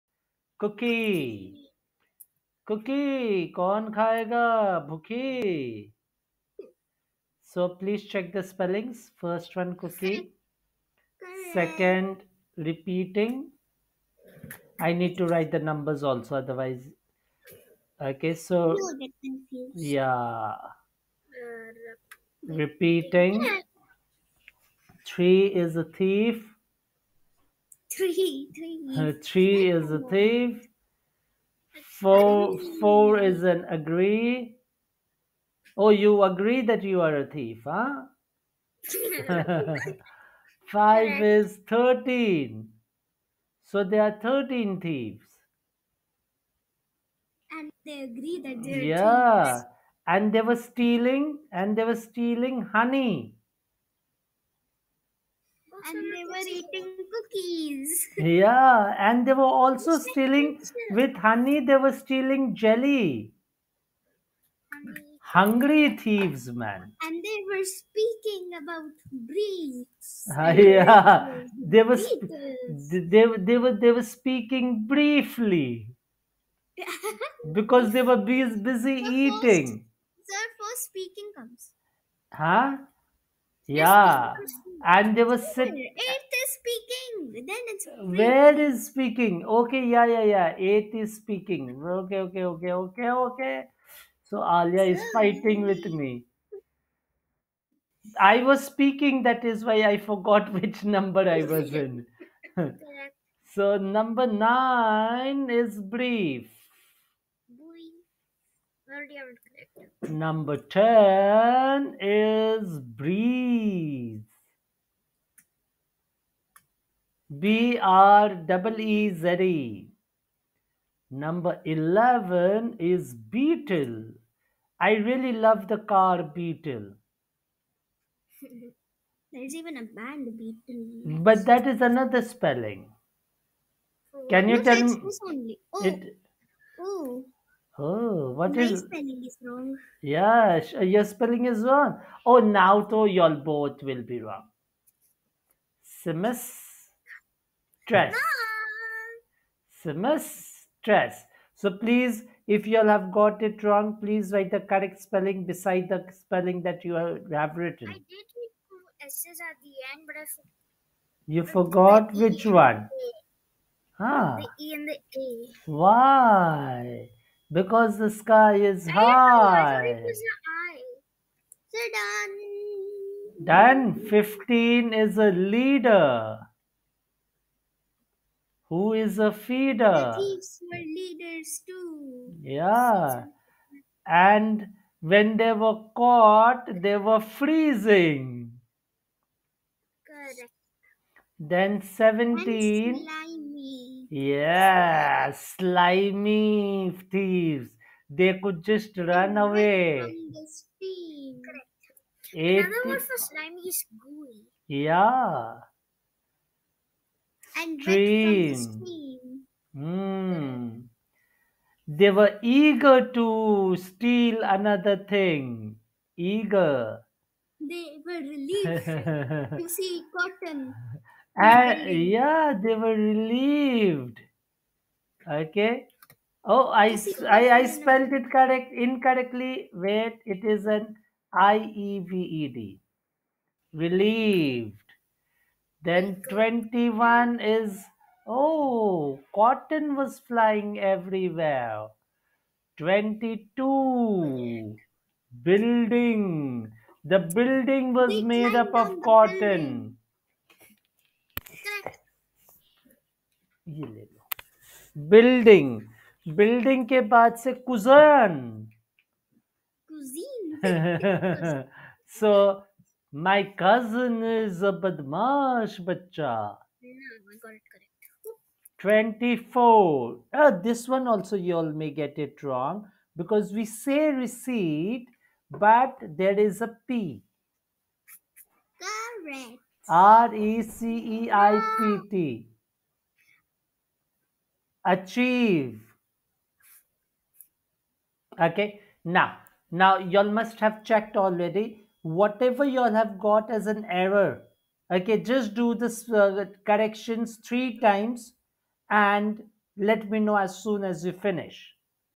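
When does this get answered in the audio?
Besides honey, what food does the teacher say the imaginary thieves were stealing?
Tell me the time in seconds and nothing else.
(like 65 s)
62 s.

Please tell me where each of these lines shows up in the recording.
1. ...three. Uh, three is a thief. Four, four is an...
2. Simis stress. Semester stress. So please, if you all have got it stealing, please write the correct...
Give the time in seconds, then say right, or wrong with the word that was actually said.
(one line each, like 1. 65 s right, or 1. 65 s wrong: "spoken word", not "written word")
1. 28 s right
2. 146 s wrong: "wrong", not "stealing".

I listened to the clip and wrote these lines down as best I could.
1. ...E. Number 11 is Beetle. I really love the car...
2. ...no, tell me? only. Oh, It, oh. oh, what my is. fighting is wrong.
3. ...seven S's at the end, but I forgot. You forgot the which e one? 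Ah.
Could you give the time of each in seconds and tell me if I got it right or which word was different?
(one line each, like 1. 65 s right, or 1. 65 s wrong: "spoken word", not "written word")
1. 119 s right
2. 134 s wrong: "spelling", not "fighting"
3. 158 s wrong: "two", not "seven".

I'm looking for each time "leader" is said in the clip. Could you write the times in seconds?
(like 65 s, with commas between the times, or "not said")
175 s, 180 s.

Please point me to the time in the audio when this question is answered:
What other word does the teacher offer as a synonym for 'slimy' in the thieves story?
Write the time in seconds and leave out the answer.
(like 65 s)
203 s.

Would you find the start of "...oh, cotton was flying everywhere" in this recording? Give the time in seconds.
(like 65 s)
238 s.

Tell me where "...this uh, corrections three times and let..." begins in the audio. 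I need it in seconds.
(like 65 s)
295 s.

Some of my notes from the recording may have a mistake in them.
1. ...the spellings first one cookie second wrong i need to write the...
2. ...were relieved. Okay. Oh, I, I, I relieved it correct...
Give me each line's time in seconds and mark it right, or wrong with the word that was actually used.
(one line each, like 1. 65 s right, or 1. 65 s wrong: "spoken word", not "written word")
1. 8 s wrong: "repeating", not "wrong"
2. 222 s wrong: "spelled", not "relieved".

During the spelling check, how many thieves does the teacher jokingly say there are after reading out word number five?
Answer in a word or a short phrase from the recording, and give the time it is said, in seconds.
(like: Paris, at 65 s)
13, at 43 s.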